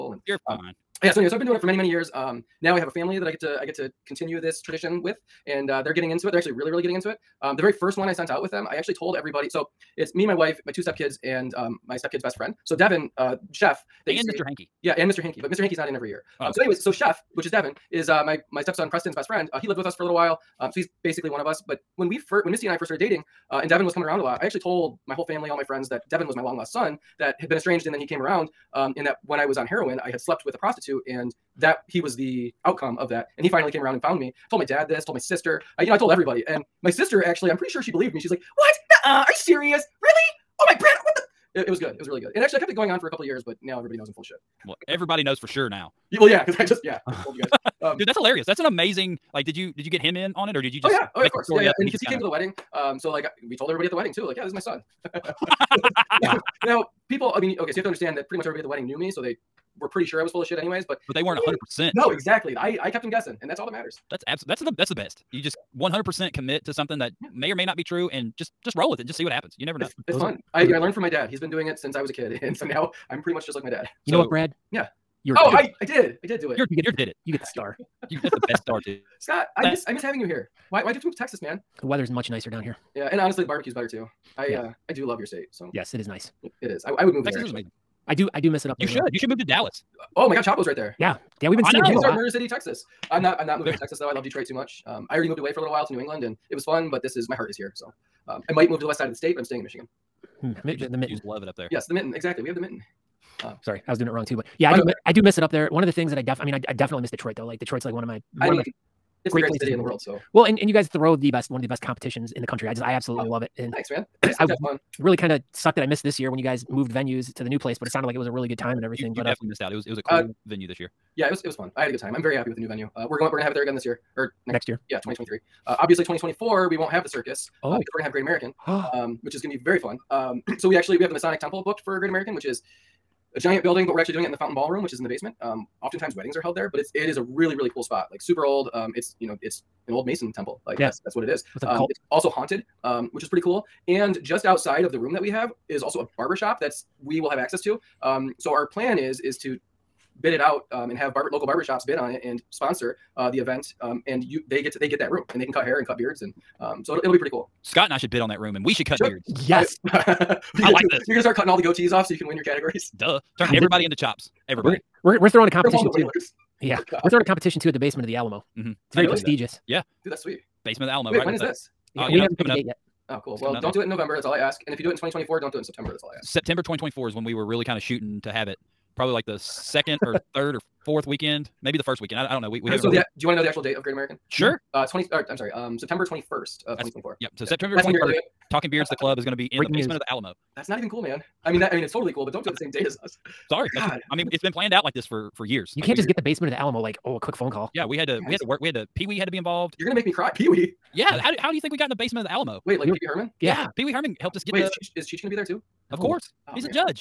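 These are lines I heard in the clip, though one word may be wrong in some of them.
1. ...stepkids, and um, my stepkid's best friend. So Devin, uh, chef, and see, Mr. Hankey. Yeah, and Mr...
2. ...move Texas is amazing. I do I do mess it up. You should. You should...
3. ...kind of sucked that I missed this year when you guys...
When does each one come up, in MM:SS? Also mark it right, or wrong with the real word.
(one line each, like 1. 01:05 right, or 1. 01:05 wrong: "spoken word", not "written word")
1. 00:10 right
2. 01:27 right
3. 01:55 right.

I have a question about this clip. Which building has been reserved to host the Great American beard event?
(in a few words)
Masonic Temple.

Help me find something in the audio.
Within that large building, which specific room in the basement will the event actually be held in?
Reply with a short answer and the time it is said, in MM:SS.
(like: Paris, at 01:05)
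Fountain Ballroom, at 02:14.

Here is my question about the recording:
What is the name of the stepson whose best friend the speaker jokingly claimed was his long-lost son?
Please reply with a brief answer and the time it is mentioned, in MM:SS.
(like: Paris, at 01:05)
Preston, at 00:18.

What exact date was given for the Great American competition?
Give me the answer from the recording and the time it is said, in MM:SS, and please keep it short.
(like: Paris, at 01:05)
September 21, 2024, at 03:05.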